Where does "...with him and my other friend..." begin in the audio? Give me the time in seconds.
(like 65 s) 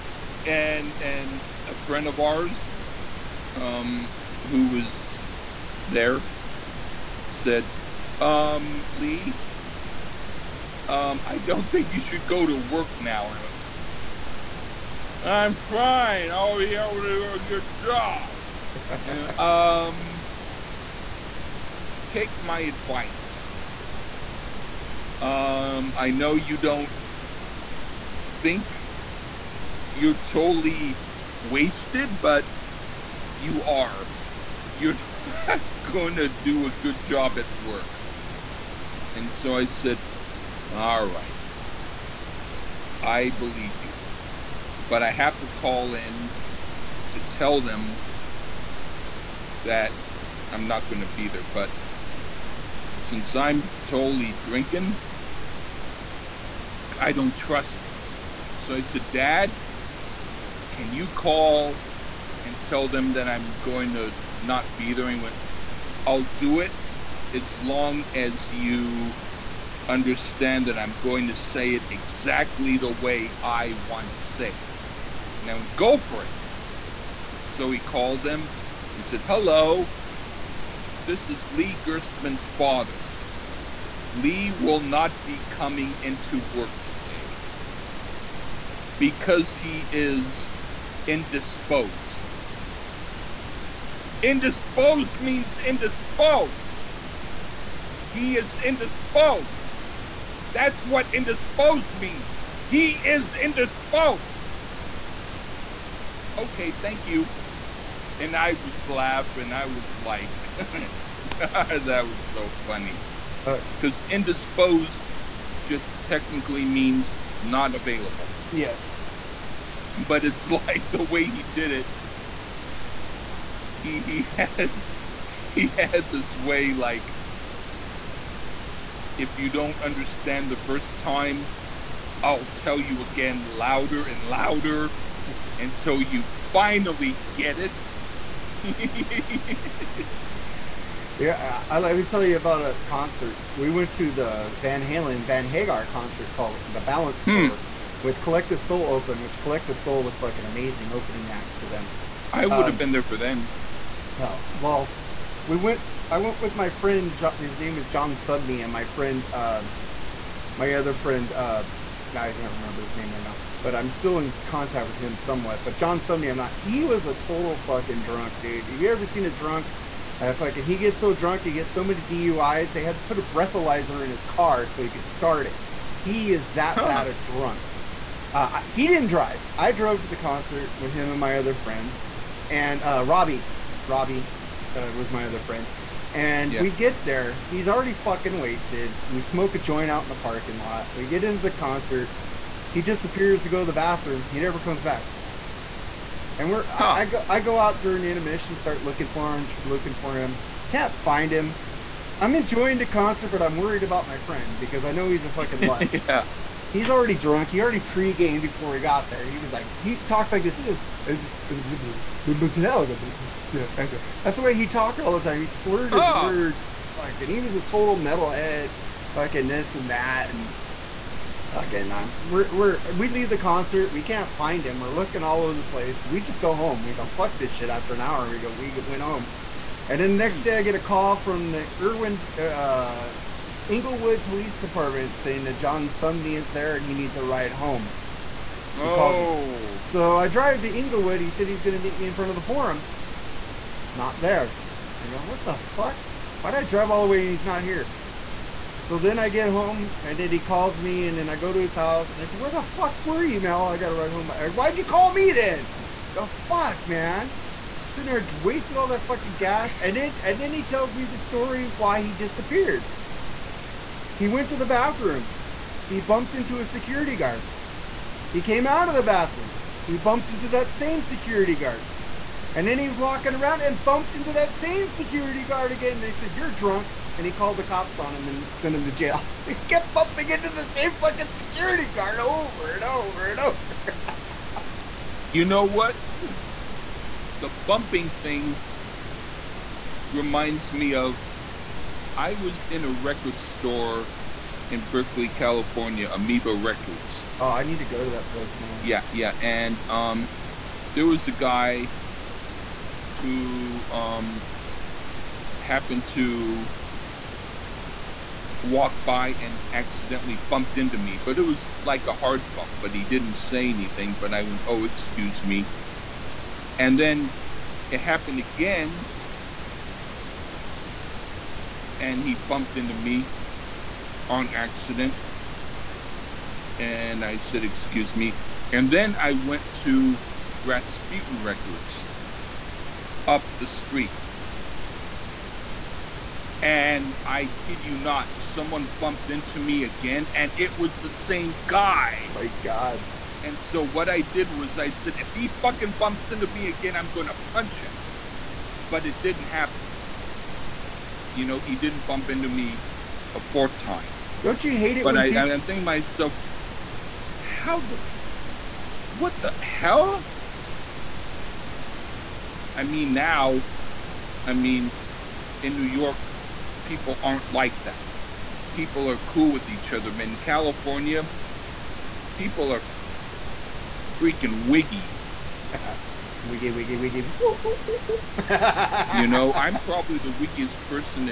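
180 s.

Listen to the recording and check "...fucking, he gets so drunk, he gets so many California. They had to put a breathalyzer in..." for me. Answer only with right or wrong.
wrong.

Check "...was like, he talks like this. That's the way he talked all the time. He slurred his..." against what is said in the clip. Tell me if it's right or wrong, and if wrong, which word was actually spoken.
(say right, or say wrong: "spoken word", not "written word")
right.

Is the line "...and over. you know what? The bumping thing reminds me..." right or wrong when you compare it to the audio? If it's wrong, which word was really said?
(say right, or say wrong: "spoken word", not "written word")
right.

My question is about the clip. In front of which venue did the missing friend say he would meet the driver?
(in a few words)
The Forum.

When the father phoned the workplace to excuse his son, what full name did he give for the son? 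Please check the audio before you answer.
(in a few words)
Lee Gerstmann.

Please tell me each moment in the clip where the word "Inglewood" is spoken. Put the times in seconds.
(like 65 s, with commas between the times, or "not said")
233 s, 240 s.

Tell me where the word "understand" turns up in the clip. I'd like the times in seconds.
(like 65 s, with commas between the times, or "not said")
69 s, 129 s.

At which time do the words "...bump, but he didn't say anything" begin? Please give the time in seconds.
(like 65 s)
312 s.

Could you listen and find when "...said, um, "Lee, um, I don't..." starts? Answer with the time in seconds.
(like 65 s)
7 s.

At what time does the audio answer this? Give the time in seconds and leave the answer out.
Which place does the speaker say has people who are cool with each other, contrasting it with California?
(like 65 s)
365 s.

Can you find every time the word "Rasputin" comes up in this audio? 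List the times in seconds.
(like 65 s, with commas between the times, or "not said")
330 s.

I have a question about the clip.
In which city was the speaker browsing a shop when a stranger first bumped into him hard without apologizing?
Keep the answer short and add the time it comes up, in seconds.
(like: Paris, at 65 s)
Berkeley, California, at 294 s.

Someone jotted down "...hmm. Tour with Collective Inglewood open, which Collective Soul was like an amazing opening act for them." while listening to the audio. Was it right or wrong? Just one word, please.
wrong.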